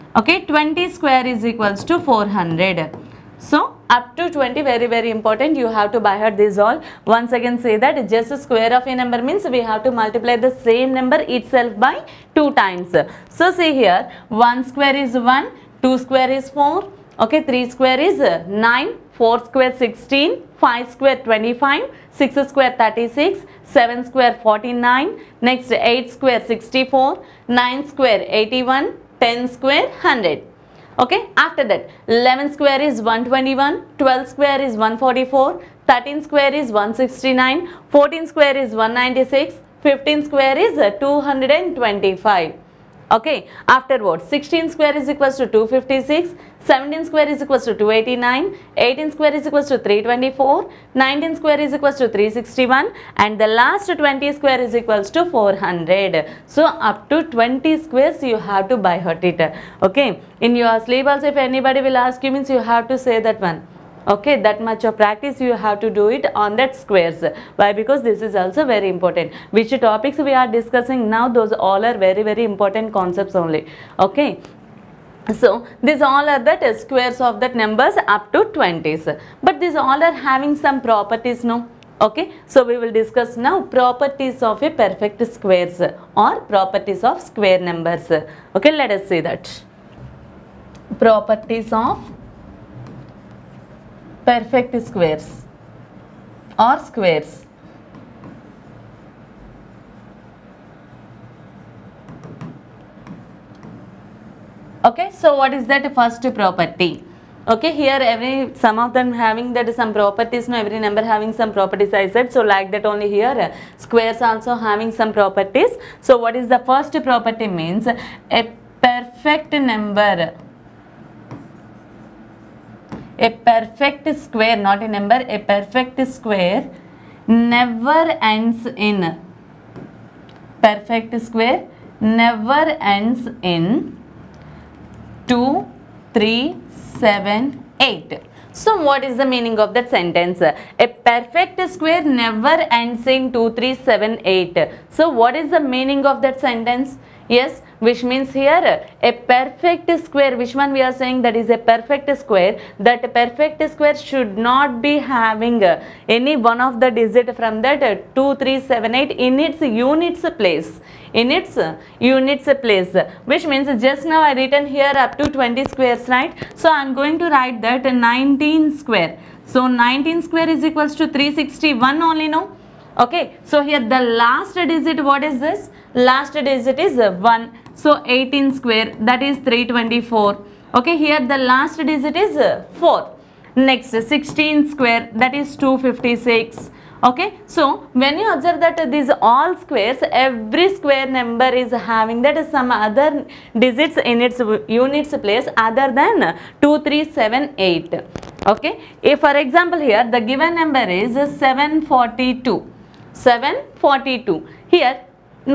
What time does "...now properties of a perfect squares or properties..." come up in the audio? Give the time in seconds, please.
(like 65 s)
83 s.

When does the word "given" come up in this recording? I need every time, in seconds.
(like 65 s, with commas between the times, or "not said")
200 s.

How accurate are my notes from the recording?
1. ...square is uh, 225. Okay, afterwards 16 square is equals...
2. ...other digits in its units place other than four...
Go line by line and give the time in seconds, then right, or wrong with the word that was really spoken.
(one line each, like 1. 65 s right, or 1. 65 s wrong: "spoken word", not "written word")
1. 40 s right
2. 192 s wrong: "two", not "four".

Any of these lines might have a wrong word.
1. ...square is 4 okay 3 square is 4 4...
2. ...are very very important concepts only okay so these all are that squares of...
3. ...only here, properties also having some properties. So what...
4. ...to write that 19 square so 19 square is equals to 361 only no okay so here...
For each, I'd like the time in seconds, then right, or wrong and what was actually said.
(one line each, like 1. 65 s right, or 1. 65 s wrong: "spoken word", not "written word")
1. 16 s wrong: "9", not "4"
2. 71 s right
3. 112 s wrong: "squares", not "properties"
4. 167 s right.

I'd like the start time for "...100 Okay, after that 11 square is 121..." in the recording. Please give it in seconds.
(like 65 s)
29 s.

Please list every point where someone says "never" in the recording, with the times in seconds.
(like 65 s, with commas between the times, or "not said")
127 s, 131 s, 142 s.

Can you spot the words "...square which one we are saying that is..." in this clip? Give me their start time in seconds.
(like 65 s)
150 s.